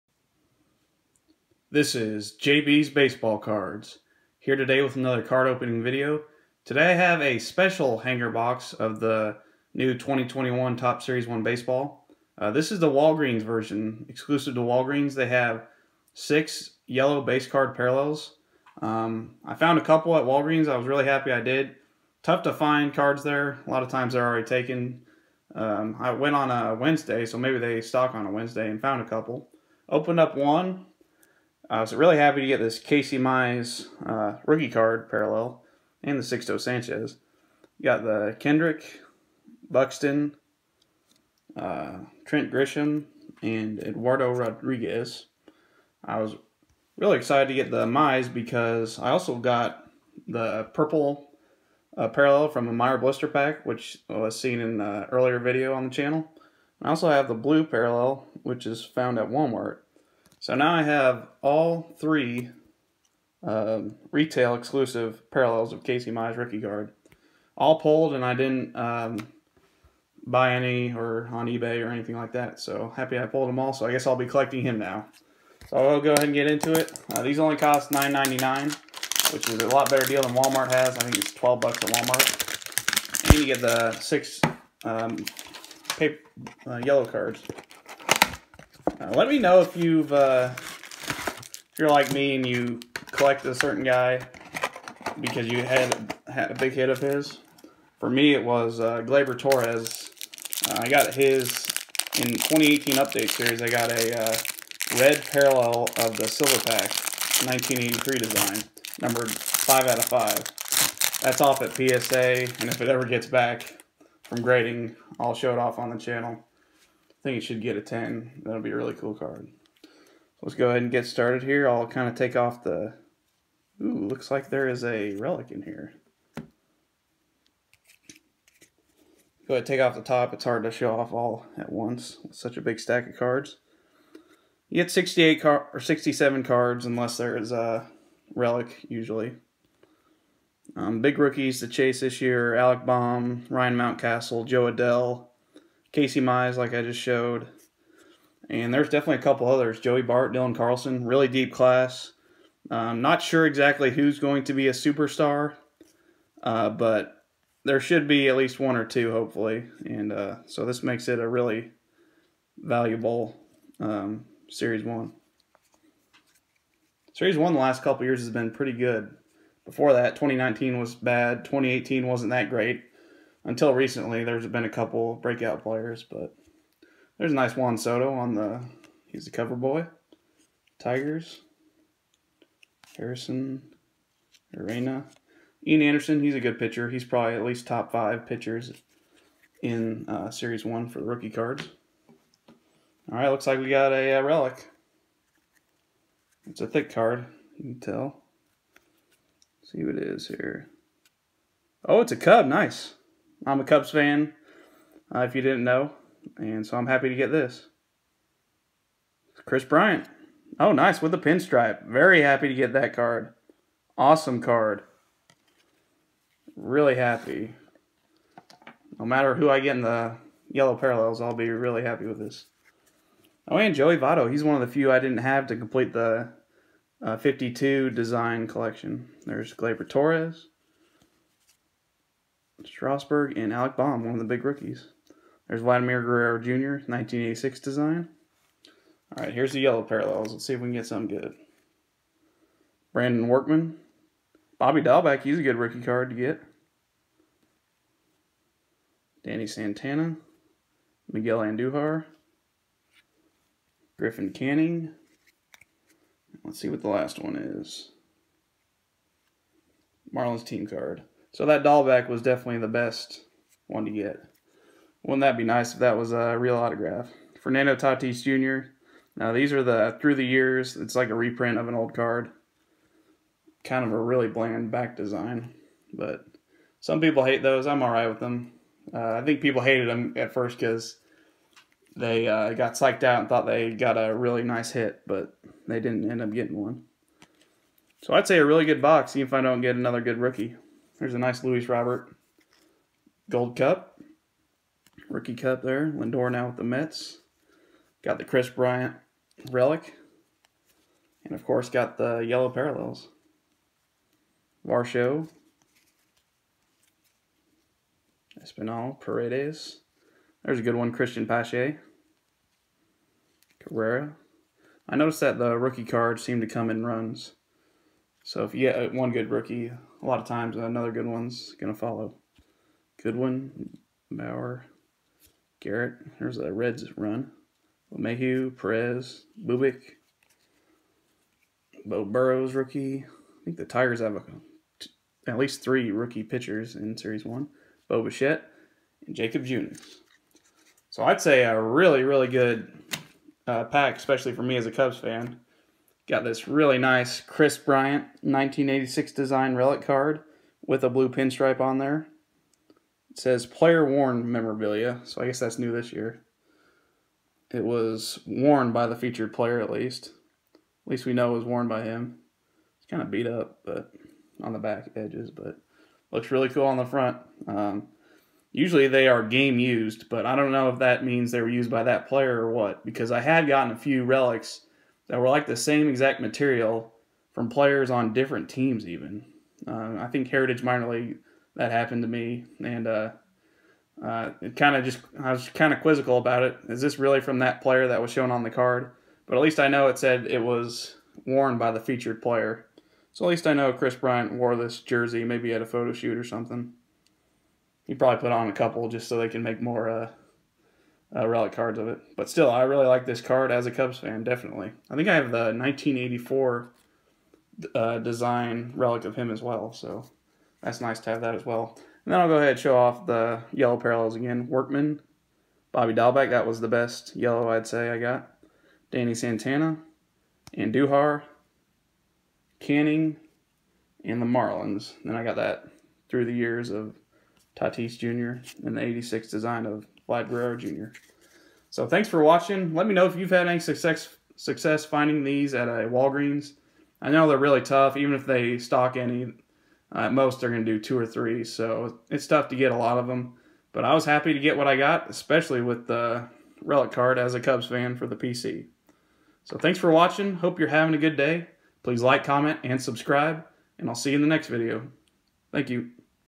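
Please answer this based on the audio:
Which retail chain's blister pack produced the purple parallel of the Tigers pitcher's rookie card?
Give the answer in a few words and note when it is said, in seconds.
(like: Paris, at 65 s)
Meijer, at 52 s.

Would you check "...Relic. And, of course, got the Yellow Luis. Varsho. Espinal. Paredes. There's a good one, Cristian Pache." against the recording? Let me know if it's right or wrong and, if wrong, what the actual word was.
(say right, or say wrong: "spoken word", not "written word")
wrong: "Parallels", not "Luis".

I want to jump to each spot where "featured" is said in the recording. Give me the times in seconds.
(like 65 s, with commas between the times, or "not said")
358 s, 391 s.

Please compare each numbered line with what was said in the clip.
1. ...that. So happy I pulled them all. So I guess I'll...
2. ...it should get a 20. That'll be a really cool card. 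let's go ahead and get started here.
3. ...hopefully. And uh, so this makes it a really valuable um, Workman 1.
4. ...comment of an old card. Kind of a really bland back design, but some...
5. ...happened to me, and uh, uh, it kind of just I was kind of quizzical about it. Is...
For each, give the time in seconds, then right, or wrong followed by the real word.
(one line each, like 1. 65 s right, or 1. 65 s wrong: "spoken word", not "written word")
1. 72 s right
2. 117 s wrong: "10", not "20"
3. 159 s wrong: "Series", not "Workman"
4. 271 s wrong: "reprint", not "comment"
5. 381 s right.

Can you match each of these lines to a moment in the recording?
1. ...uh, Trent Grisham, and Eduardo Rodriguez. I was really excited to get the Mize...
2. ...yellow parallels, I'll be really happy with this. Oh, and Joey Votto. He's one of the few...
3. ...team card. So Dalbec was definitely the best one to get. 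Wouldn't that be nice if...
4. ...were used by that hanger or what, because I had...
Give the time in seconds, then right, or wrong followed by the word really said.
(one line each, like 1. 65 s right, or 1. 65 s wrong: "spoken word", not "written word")
1. 41 s right
2. 220 s right
3. 260 s right
4. 371 s wrong: "player", not "hanger".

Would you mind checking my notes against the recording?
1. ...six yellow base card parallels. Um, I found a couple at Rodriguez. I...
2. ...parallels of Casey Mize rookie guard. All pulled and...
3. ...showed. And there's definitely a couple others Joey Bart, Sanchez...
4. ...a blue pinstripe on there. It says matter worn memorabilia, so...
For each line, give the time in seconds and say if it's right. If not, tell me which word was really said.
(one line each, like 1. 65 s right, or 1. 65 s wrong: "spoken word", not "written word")
1. 16 s wrong: "Walgreens", not "Rodriguez"
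2. 65 s right
3. 146 s wrong: "Dylan", not "Sanchez"
4. 350 s wrong: "player", not "matter".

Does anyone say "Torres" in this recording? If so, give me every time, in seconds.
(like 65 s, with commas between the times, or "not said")
99 s, 229 s.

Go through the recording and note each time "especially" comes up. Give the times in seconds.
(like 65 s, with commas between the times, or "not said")
343 s, 445 s.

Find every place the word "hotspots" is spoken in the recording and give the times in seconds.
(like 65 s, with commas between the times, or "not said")
not said.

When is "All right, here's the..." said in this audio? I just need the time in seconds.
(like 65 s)
239 s.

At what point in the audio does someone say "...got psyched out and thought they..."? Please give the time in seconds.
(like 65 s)
282 s.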